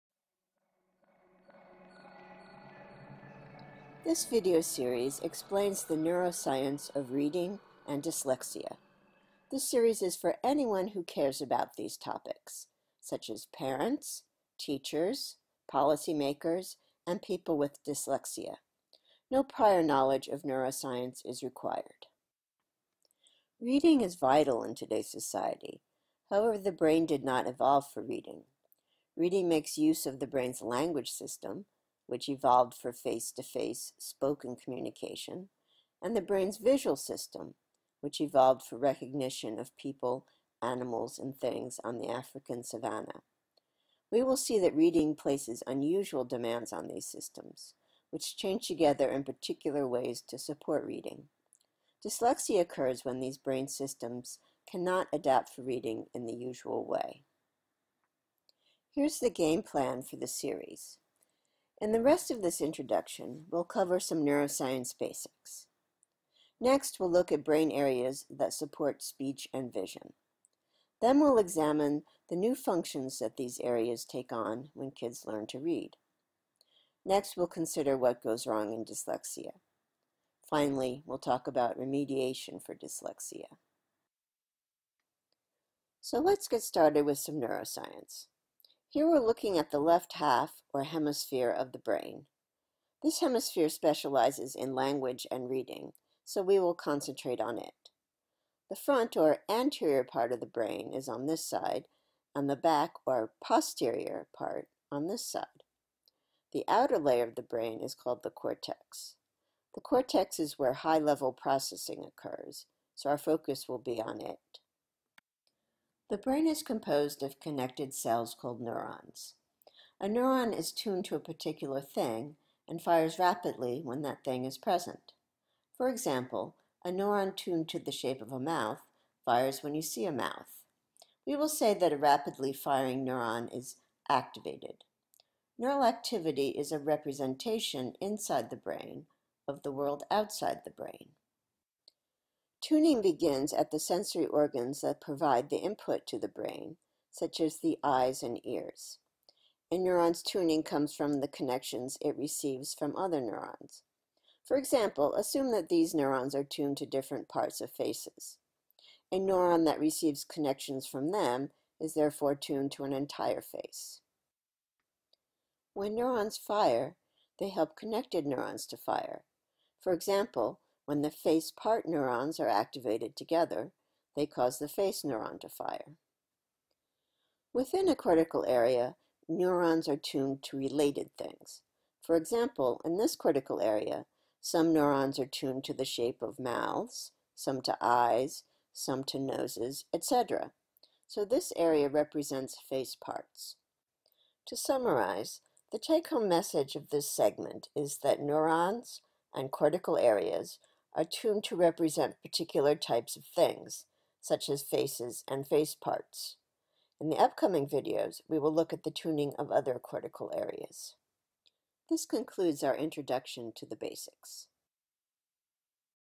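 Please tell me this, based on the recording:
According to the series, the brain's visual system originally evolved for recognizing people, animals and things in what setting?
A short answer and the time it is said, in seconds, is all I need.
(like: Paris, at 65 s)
African savanna, at 42 s.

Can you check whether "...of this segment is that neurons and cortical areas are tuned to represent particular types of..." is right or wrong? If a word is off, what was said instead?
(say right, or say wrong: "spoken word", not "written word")
right.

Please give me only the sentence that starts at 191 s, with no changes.
So this area represents face parts.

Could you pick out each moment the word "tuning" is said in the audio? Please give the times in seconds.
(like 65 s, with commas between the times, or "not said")
142 s, 150 s, 208 s.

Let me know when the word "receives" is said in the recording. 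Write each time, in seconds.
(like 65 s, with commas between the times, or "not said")
152 s, 159 s.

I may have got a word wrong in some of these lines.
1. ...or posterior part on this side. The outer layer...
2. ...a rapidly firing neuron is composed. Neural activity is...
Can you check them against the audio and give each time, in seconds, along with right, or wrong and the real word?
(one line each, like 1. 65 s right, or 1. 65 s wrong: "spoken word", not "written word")
1. 103 s right
2. 131 s wrong: "activated", not "composed".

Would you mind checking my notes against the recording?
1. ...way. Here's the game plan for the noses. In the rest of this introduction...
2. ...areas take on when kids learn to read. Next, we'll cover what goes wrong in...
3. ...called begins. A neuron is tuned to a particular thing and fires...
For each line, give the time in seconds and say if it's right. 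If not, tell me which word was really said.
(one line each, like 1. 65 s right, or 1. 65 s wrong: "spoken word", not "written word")
1. 56 s wrong: "series", not "noses"
2. 73 s wrong: "consider", not "cover"
3. 118 s wrong: "neurons", not "begins".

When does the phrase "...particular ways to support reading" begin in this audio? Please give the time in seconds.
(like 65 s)
49 s.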